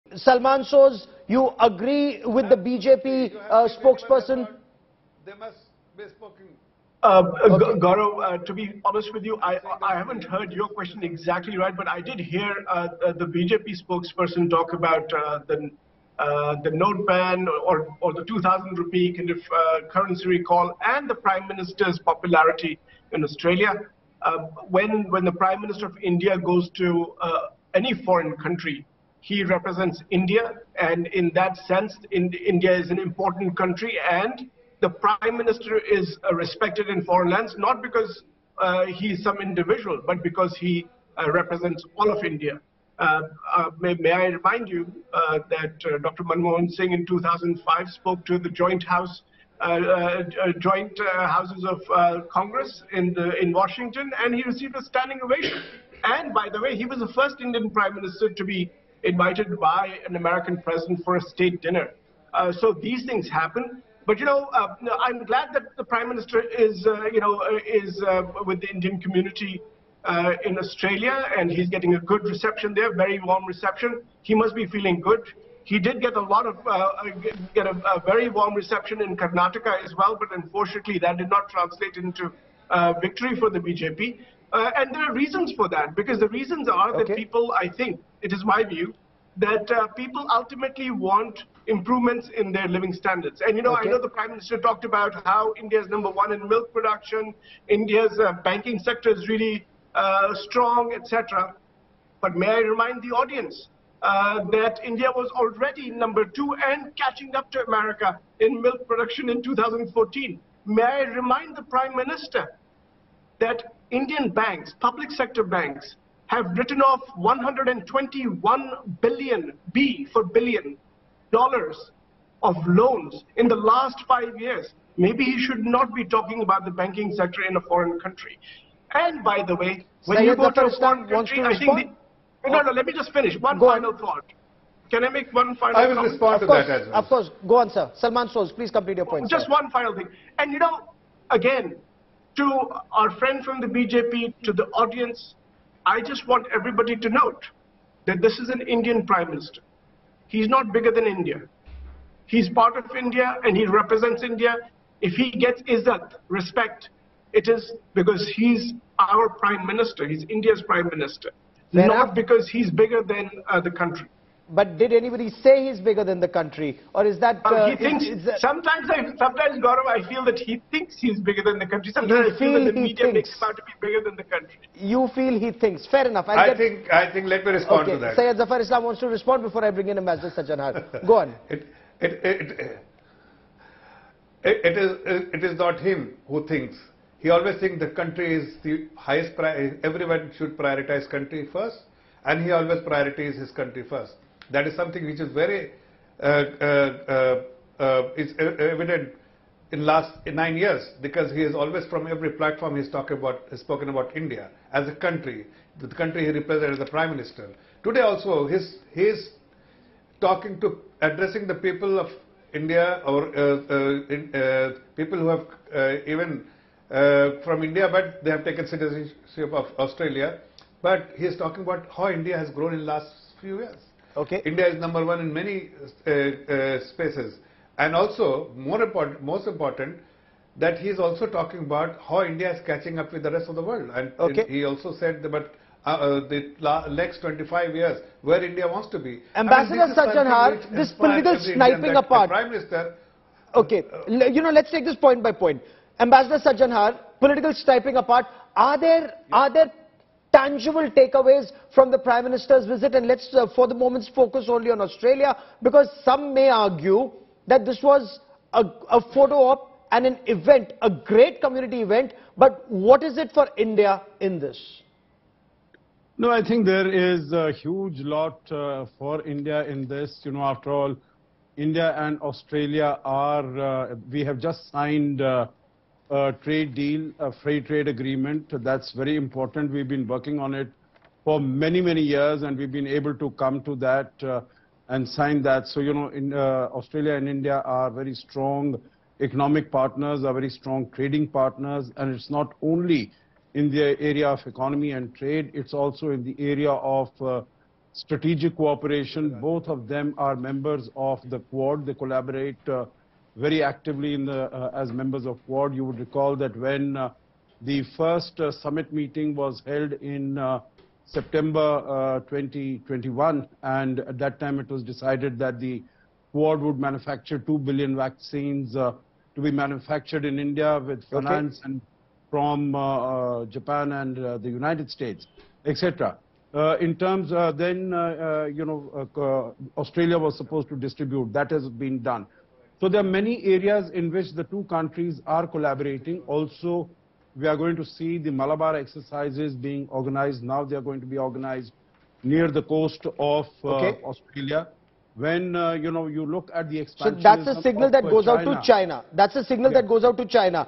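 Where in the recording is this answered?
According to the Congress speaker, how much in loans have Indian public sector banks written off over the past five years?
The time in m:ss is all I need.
1:57.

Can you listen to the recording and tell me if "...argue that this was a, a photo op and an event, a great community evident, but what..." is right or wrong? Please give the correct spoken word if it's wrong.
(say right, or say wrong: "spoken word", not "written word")
wrong: "event", not "evident".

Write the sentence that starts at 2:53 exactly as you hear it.
makes him out to be bigger than the country.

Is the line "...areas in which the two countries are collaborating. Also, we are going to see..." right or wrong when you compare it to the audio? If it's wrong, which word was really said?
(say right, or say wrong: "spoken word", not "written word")
right.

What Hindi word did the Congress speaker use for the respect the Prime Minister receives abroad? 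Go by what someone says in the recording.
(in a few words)
izzat.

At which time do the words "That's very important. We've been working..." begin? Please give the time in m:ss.
4:38.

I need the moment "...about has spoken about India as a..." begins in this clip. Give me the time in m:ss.
3:23.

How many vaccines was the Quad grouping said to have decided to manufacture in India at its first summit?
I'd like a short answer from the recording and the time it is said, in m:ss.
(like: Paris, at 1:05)
2 billion, at 5:17.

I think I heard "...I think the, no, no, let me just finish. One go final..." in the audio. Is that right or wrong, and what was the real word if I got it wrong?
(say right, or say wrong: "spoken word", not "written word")
right.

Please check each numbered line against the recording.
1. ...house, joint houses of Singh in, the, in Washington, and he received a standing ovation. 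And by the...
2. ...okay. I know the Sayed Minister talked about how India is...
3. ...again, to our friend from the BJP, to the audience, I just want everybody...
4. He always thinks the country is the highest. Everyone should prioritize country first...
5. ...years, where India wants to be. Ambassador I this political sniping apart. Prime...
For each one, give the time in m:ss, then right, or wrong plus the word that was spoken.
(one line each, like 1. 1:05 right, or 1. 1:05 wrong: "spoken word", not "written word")
1. 0:48 wrong: "Congress", not "Singh"
2. 1:33 wrong: "Prime", not "Sayed"
3. 2:21 right
4. 3:07 right
5. 3:57 right.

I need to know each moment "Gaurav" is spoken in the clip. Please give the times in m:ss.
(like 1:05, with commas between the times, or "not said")
0:07, 2:49.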